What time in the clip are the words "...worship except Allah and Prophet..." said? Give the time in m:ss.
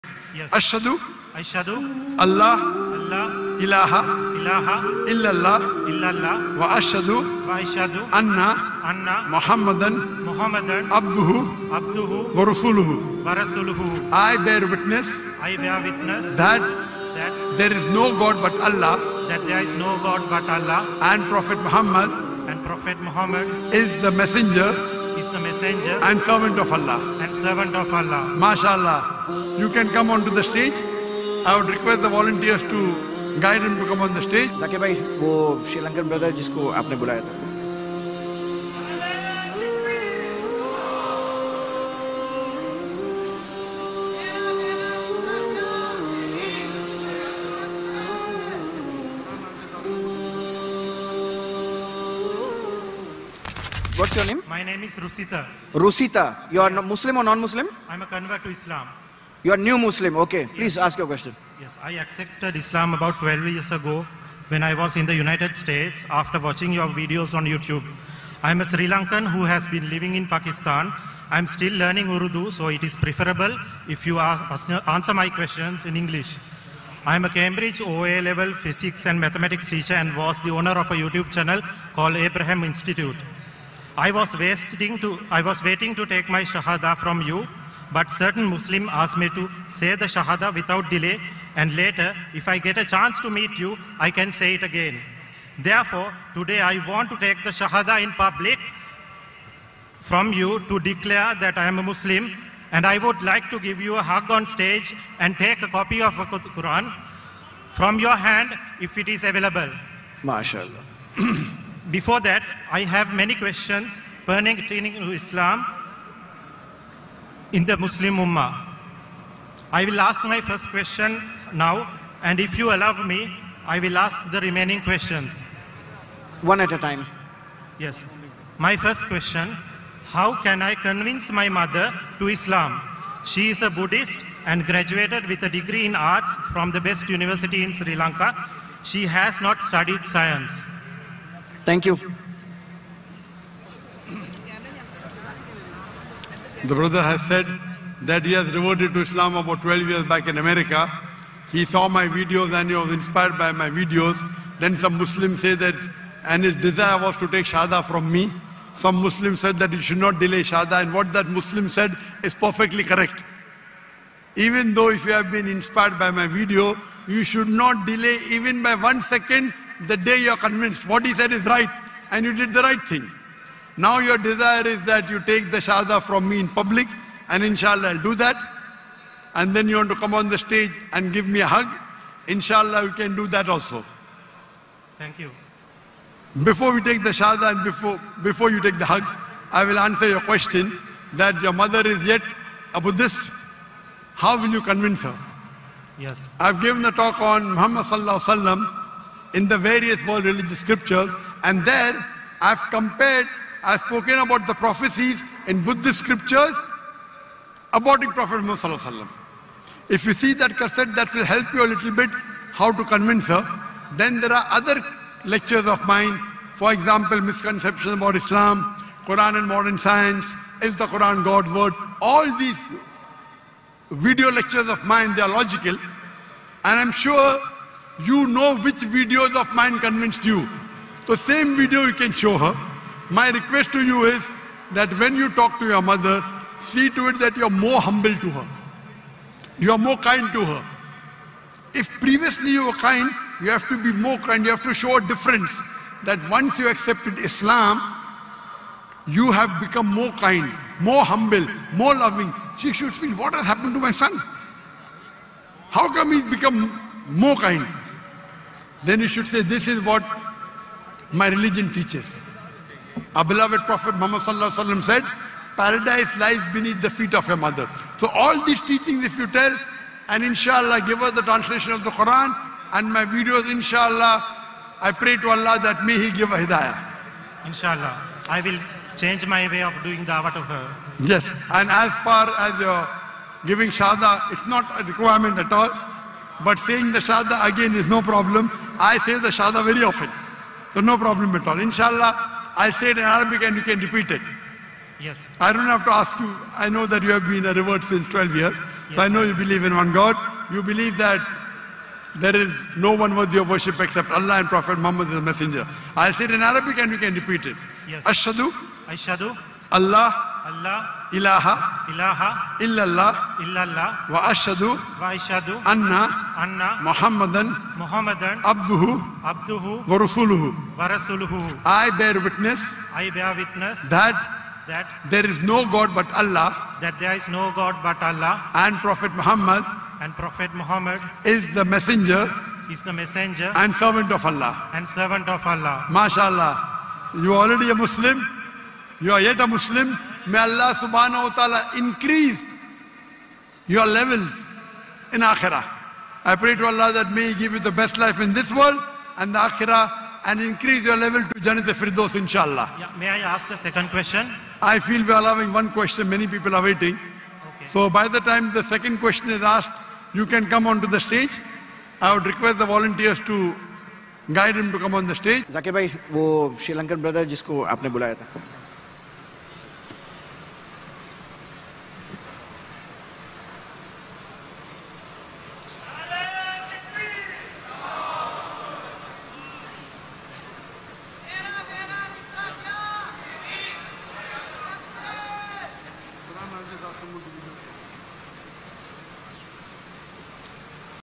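5:03.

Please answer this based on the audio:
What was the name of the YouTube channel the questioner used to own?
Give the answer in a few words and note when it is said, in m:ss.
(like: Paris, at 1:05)
Abraham Institute, at 1:22.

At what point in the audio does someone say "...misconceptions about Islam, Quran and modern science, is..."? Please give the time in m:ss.
3:37.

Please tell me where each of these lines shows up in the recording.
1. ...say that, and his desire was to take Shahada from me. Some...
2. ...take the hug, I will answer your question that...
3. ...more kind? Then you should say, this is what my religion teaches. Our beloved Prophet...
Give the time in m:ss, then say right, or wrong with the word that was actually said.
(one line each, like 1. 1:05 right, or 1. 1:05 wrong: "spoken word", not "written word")
1. 2:35 right
2. 3:08 right
3. 4:17 right.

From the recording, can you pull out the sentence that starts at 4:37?
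Inshallah, I will change my way of doing dawah to her.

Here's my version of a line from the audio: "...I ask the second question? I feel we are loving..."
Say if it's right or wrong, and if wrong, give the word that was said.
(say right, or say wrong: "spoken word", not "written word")
wrong: "having", not "loving".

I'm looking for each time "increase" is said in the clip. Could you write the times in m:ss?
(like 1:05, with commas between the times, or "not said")
5:41, 5:50.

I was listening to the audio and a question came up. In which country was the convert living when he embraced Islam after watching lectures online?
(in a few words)
United States.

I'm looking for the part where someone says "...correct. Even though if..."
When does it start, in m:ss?
2:42.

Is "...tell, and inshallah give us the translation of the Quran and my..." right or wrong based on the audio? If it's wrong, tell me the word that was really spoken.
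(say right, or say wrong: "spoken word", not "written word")
right.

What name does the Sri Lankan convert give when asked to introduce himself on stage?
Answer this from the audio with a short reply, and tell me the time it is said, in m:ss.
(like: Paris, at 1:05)
Rusita, at 0:54.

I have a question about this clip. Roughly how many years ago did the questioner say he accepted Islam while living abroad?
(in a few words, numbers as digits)
12.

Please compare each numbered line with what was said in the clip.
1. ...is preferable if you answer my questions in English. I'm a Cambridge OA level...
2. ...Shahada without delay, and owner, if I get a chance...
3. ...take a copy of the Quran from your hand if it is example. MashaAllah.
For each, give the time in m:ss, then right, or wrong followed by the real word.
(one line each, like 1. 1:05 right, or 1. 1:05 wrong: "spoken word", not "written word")
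1. 1:12 right
2. 1:30 wrong: "later", not "owner"
3. 1:45 wrong: "available", not "example".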